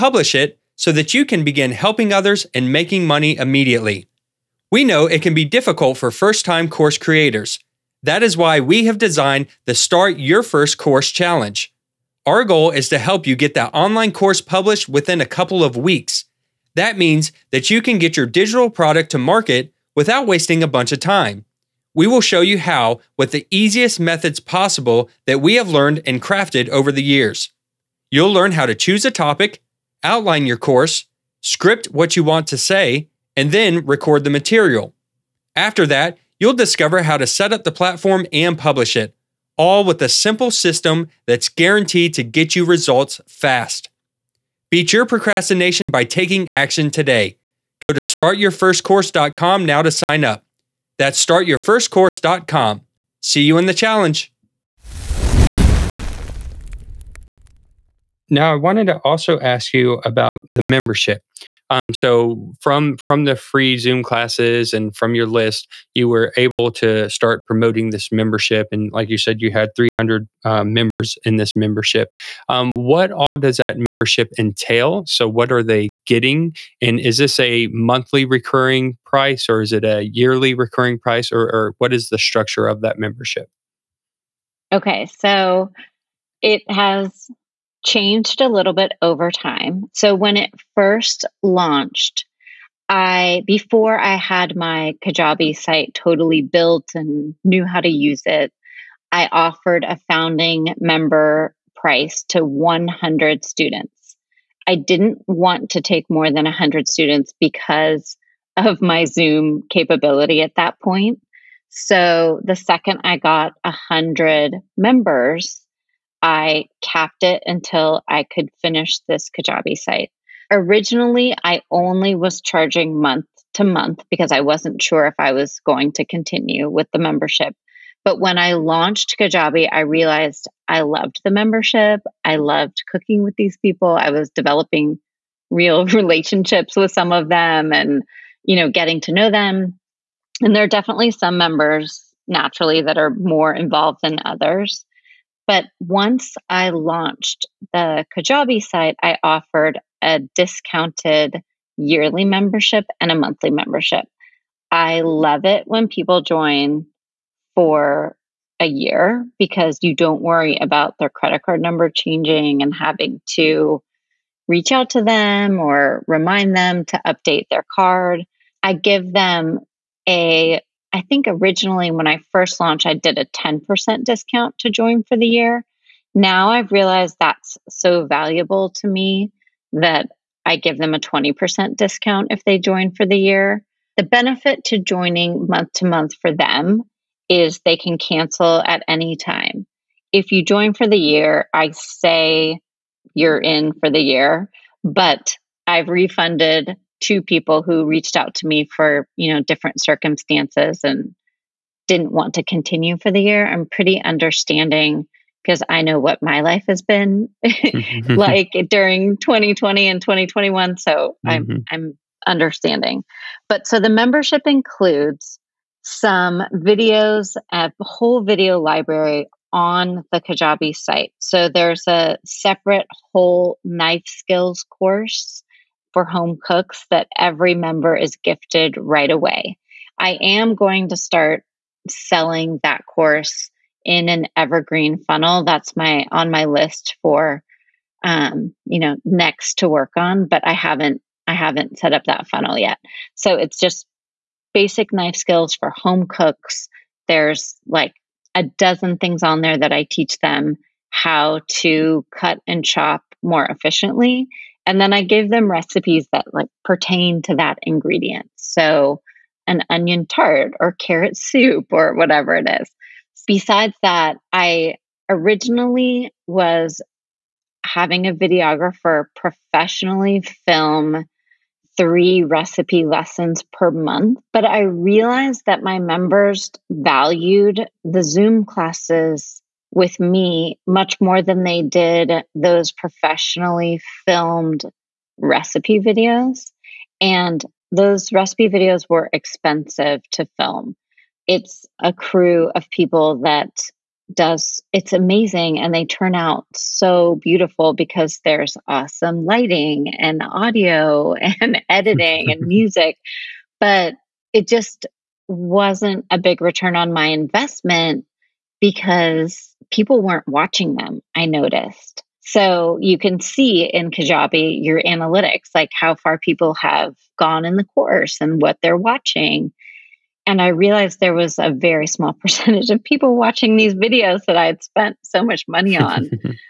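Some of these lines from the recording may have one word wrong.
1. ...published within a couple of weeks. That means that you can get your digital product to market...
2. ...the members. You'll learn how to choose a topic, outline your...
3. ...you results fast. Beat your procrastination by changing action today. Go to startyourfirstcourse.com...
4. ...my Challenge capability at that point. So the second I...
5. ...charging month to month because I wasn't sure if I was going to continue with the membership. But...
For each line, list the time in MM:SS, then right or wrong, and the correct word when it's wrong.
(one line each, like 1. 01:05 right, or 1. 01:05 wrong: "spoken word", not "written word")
1. 00:14 right
2. 00:26 wrong: "years", not "members"
3. 00:42 wrong: "taking", not "changing"
4. 01:48 wrong: "Zoom", not "Challenge"
5. 02:02 right.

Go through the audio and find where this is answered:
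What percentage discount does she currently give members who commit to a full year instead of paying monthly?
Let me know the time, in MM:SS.
03:00.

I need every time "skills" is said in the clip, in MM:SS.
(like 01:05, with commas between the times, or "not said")
03:44, 04:05.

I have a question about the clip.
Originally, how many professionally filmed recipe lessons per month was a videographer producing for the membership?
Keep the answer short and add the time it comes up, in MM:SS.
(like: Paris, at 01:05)
3, at 04:31.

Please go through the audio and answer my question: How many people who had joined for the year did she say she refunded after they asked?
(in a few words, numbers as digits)
2.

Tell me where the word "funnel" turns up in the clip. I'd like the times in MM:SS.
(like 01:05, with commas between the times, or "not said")
03:55, 04:02.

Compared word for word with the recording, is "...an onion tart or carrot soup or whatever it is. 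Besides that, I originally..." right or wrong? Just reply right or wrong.
right.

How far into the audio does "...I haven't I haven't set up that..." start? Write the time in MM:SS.
04:00.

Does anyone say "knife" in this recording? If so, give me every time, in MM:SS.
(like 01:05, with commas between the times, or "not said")
03:43, 04:04.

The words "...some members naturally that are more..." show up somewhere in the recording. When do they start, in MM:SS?
02:21.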